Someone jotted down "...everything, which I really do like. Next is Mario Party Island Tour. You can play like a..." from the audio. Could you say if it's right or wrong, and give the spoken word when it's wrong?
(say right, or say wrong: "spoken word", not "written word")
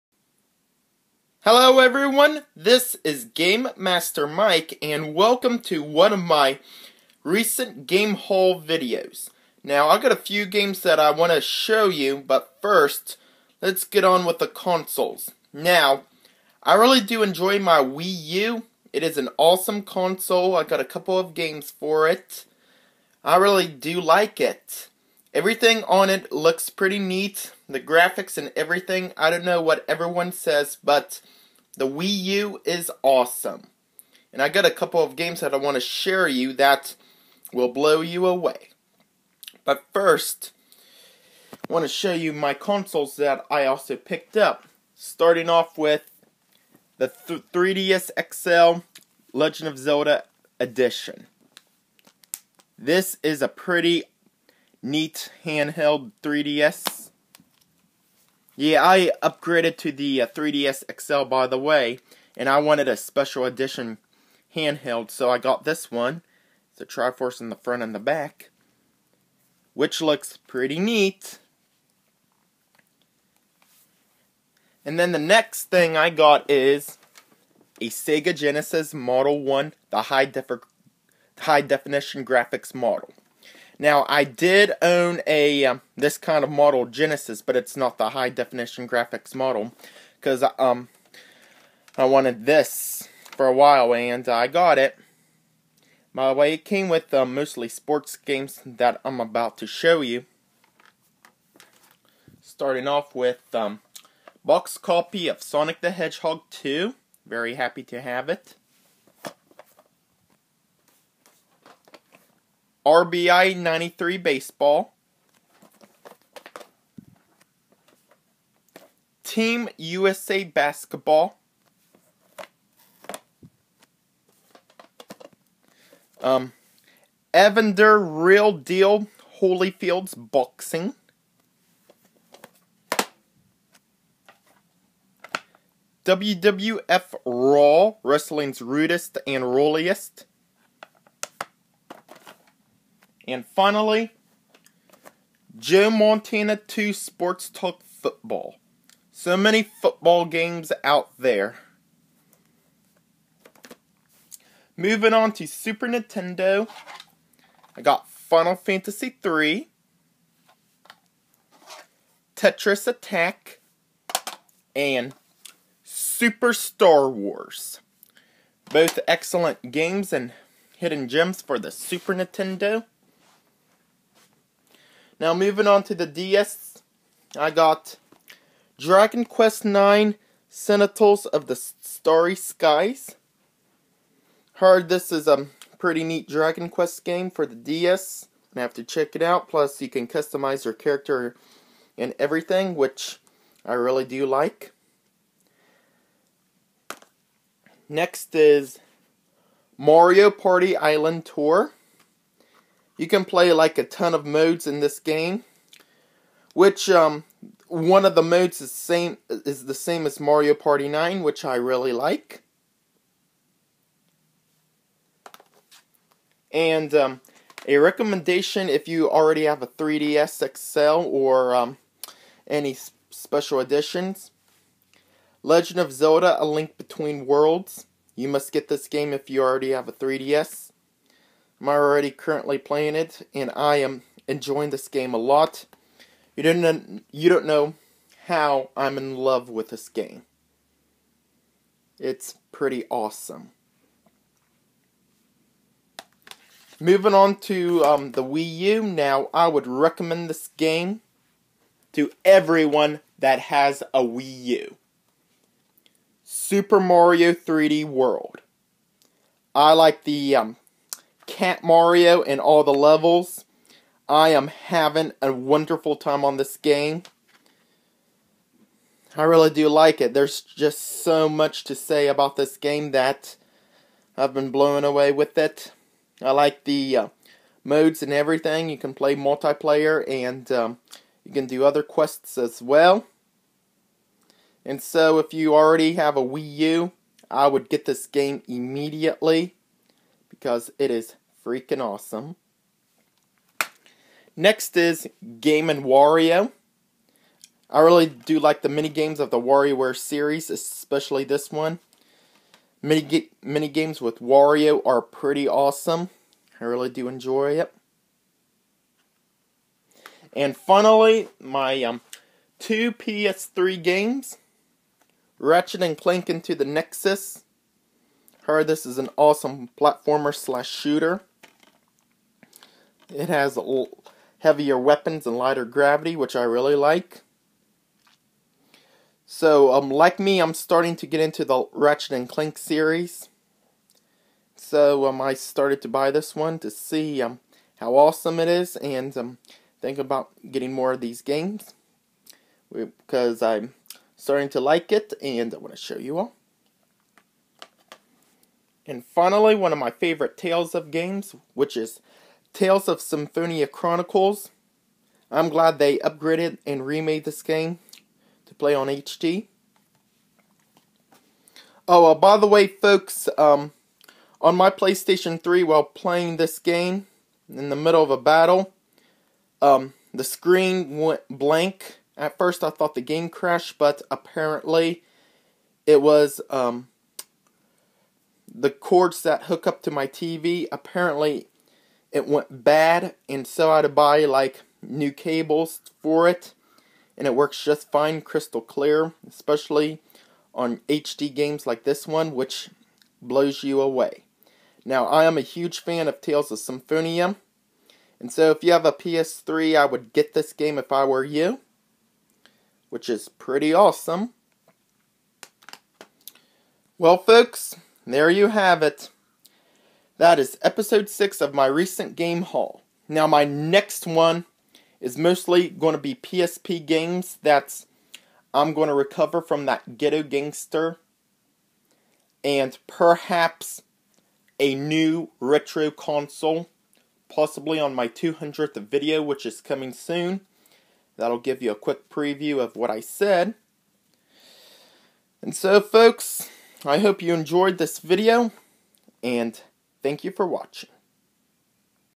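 right.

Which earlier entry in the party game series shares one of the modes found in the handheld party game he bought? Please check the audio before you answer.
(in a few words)
Mario Party 9.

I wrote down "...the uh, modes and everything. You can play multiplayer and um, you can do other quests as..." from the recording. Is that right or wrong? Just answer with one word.
right.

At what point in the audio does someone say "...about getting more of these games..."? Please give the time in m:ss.
5:39.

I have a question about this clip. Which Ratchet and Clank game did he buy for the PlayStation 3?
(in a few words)
Into the Nexus.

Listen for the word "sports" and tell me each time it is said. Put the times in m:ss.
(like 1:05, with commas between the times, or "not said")
1:37, 2:26.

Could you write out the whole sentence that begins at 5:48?
And finally, one of my favorite Tales of games, which is Tales of Symphonia Chronicles.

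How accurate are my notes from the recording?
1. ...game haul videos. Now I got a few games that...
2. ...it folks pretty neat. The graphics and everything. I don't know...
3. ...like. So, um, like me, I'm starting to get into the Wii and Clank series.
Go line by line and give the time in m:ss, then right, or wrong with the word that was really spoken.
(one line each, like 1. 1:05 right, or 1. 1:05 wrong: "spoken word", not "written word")
1. 0:07 right
2. 0:26 wrong: "looks", not "folks"
3. 5:26 wrong: "Ratchet", not "Wii".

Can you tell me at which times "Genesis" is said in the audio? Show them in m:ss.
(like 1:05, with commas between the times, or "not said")
1:18, 1:26.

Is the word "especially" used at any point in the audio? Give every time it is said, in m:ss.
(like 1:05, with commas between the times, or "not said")
5:00, 6:29.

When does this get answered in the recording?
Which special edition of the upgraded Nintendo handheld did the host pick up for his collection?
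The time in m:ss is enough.
0:49.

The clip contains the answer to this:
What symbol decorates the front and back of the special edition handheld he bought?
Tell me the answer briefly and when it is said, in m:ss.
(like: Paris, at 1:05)
Triforce, at 1:06.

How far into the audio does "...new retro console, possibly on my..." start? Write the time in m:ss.
7:04.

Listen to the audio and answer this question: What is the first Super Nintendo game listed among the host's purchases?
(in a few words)
Final Fantasy III.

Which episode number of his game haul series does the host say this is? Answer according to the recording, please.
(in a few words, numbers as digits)
6.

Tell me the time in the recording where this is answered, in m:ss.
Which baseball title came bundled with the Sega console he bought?
1:52.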